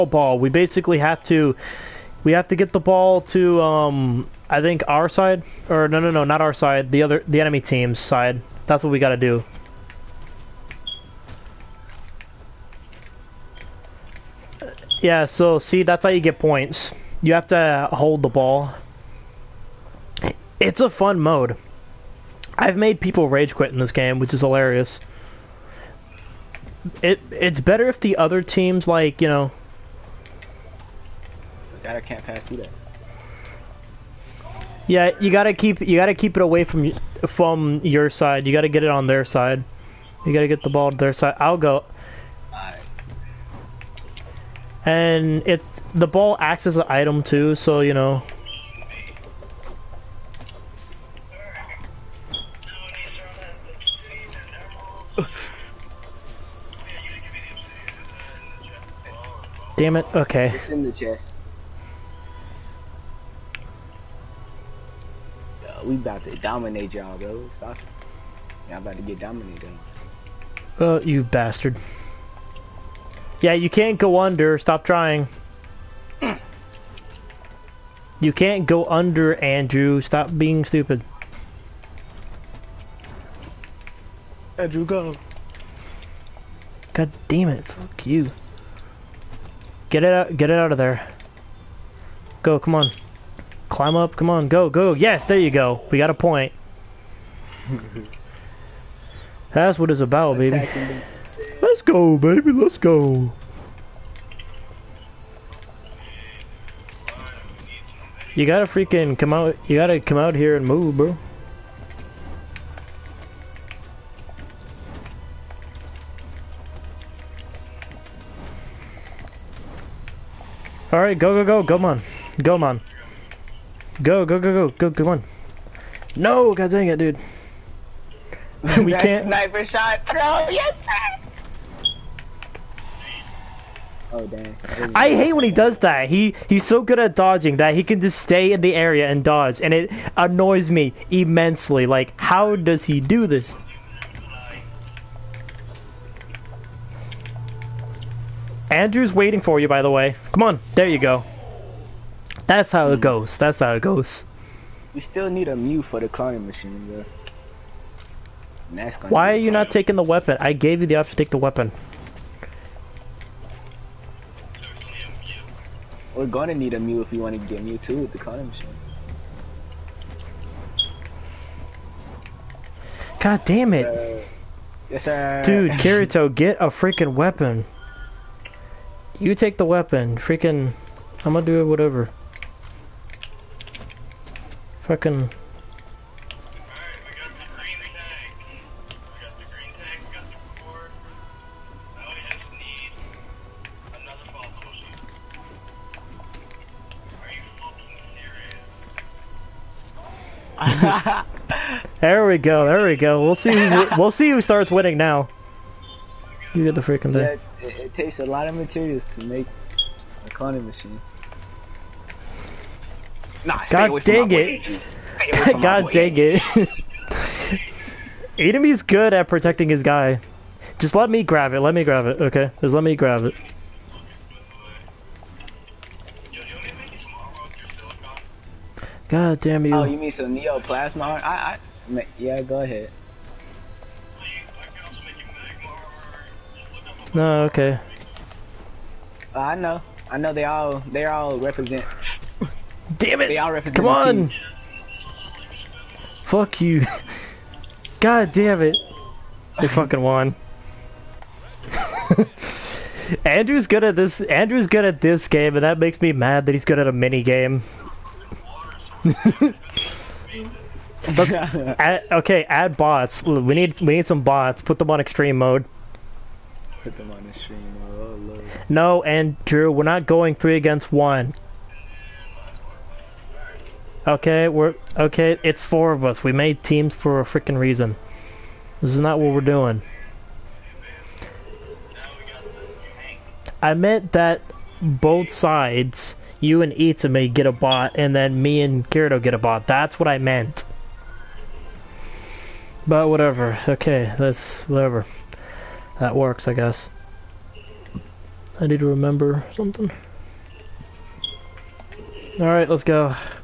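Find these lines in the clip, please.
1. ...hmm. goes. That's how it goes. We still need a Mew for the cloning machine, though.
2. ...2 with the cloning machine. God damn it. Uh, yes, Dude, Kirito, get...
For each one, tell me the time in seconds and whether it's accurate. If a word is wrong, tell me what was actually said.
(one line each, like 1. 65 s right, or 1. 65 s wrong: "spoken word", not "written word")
1. 152 s right
2. 167 s right.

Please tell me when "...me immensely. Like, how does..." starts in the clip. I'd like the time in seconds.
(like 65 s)
140 s.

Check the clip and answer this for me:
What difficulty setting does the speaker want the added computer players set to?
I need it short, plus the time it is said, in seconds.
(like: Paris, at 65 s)
extreme mode, at 265 s.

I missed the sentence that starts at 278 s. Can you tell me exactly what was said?
This is not what we're doing.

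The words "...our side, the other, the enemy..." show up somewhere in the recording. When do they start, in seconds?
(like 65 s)
6 s.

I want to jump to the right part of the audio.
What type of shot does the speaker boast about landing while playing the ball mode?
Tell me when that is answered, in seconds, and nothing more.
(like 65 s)
129 s.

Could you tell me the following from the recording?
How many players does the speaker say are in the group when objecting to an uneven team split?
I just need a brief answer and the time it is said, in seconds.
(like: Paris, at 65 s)
4, at 275 s.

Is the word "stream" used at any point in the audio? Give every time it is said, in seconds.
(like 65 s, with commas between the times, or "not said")
267 s.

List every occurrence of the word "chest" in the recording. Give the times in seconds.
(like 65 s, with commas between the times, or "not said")
60 s.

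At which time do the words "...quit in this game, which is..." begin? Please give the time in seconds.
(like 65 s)
23 s.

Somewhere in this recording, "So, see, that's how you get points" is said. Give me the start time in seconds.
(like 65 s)
15 s.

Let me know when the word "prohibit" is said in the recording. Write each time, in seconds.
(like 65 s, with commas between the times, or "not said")
not said.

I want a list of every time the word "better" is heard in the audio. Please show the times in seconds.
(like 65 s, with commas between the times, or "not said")
27 s.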